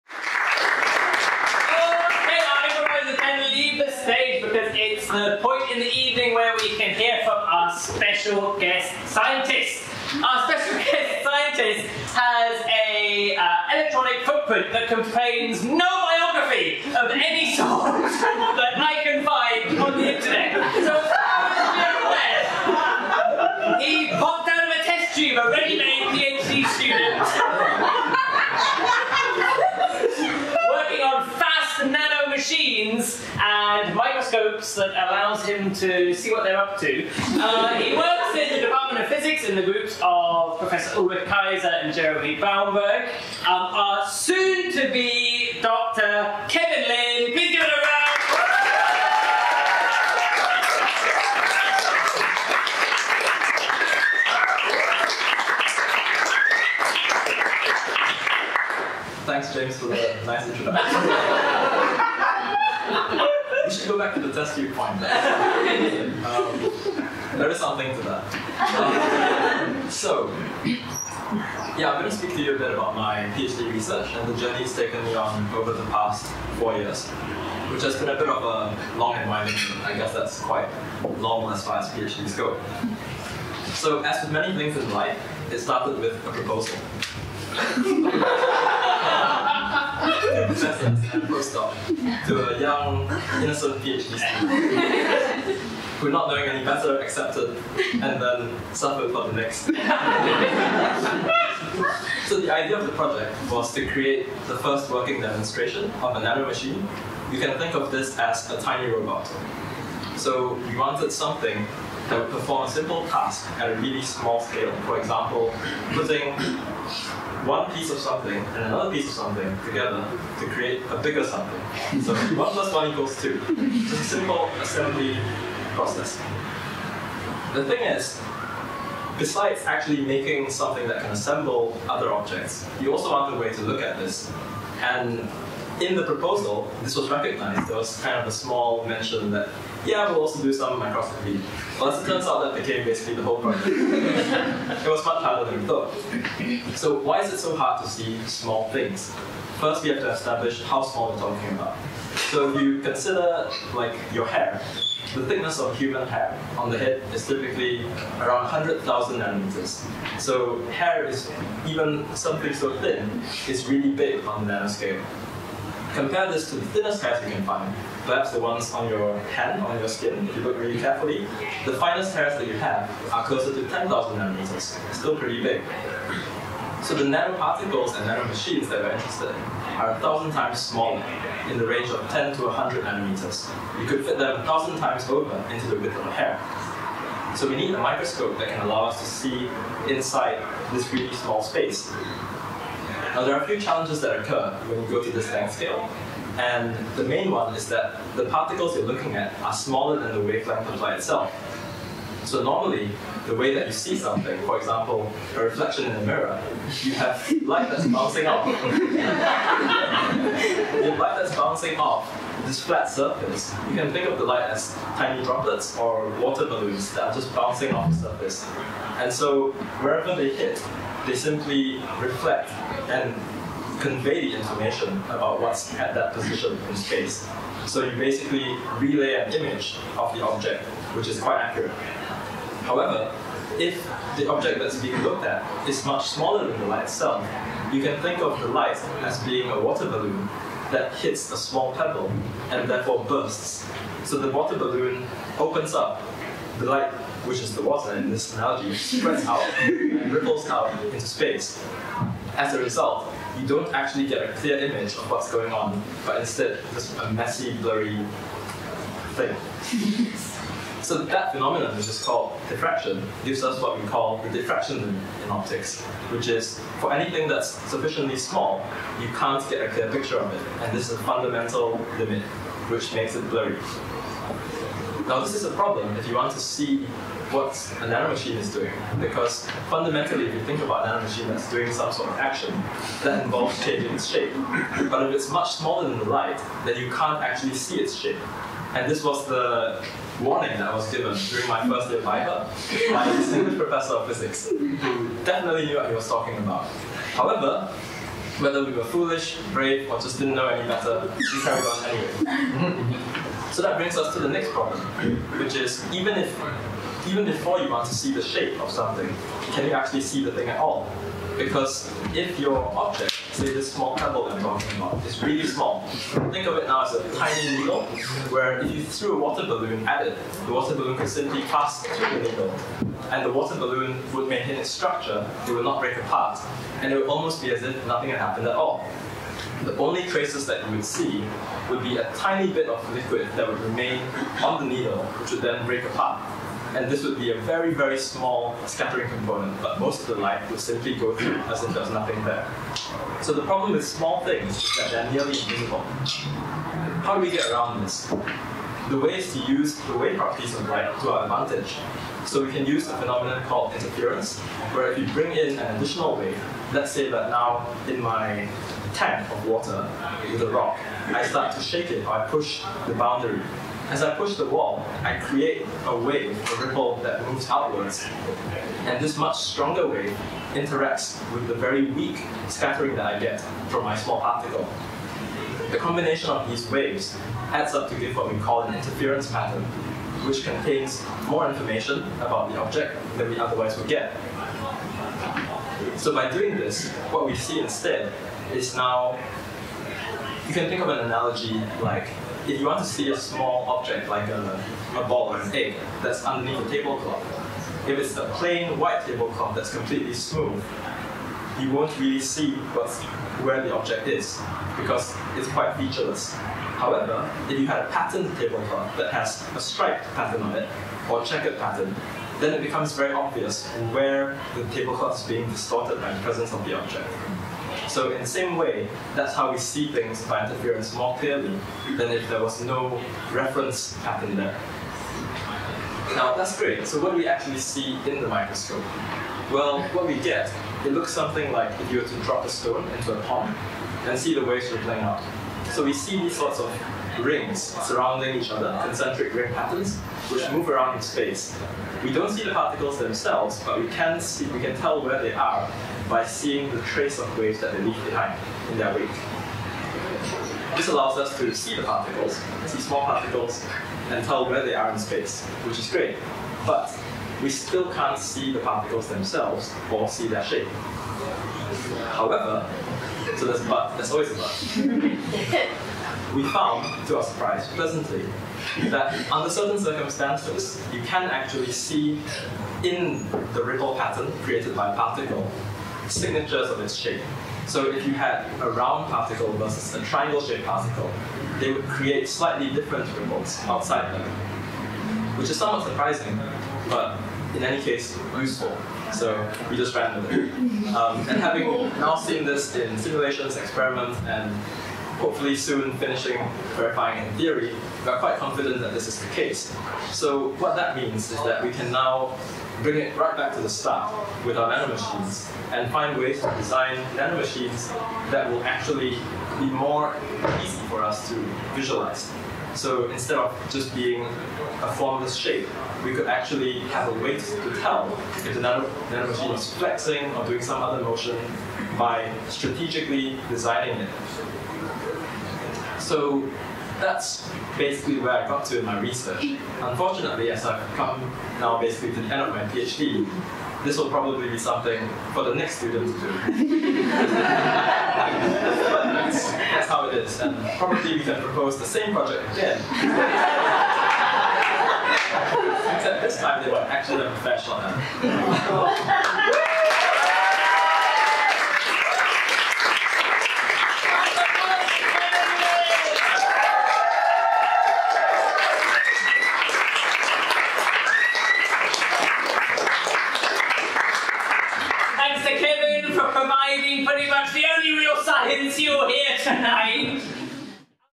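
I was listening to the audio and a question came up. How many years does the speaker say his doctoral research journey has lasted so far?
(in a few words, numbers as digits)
4.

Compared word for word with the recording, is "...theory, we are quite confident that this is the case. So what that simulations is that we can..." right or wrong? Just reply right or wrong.
wrong.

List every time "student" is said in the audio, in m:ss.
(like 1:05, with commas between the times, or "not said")
1:34, 8:55.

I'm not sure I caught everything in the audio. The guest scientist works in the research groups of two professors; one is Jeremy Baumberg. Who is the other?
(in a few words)
Ulrich Keyser.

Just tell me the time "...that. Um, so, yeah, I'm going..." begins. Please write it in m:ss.
1:08.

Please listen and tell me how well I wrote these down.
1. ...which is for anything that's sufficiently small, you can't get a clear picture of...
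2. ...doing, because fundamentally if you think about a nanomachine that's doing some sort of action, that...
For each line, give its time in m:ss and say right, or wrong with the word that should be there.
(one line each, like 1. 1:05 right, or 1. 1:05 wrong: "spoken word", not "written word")
1. 4:26 right
2. 4:38 right.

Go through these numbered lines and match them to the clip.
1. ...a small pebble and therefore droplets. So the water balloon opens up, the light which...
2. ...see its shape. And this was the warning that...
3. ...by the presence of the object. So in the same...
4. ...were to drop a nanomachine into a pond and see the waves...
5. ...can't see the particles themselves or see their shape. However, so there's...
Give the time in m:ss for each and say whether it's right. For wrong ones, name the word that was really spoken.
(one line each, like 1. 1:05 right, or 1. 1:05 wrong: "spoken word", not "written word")
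1. 4:01 wrong: "bursts", not "droplets"
2. 4:47 right
3. 6:56 right
4. 7:12 wrong: "stone", not "nanomachine"
5. 7:37 right.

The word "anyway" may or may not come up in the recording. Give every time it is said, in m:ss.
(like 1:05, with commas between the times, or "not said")
5:01.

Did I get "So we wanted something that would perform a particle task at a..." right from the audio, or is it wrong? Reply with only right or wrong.
wrong.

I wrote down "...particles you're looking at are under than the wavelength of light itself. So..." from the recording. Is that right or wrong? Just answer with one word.
wrong.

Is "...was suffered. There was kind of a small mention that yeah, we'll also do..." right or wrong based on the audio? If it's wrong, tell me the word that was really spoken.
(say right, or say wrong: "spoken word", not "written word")
wrong: "recognized", not "suffered".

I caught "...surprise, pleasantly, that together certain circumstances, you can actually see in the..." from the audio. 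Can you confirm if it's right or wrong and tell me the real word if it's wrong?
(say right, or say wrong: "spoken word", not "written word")
wrong: "under", not "together".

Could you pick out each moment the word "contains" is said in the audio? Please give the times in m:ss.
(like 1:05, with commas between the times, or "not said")
0:14, 6:20.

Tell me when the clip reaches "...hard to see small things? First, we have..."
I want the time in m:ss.
2:27.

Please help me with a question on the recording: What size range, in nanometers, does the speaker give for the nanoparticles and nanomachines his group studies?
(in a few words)
10 to 100 nanometers.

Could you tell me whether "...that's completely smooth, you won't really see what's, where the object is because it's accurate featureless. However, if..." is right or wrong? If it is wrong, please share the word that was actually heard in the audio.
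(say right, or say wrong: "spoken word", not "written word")
wrong: "quite", not "accurate".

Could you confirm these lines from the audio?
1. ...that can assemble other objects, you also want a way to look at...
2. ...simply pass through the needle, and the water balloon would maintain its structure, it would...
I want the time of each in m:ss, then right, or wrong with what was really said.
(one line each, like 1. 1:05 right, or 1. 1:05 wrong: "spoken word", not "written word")
1. 2:10 right
2. 5:21 right.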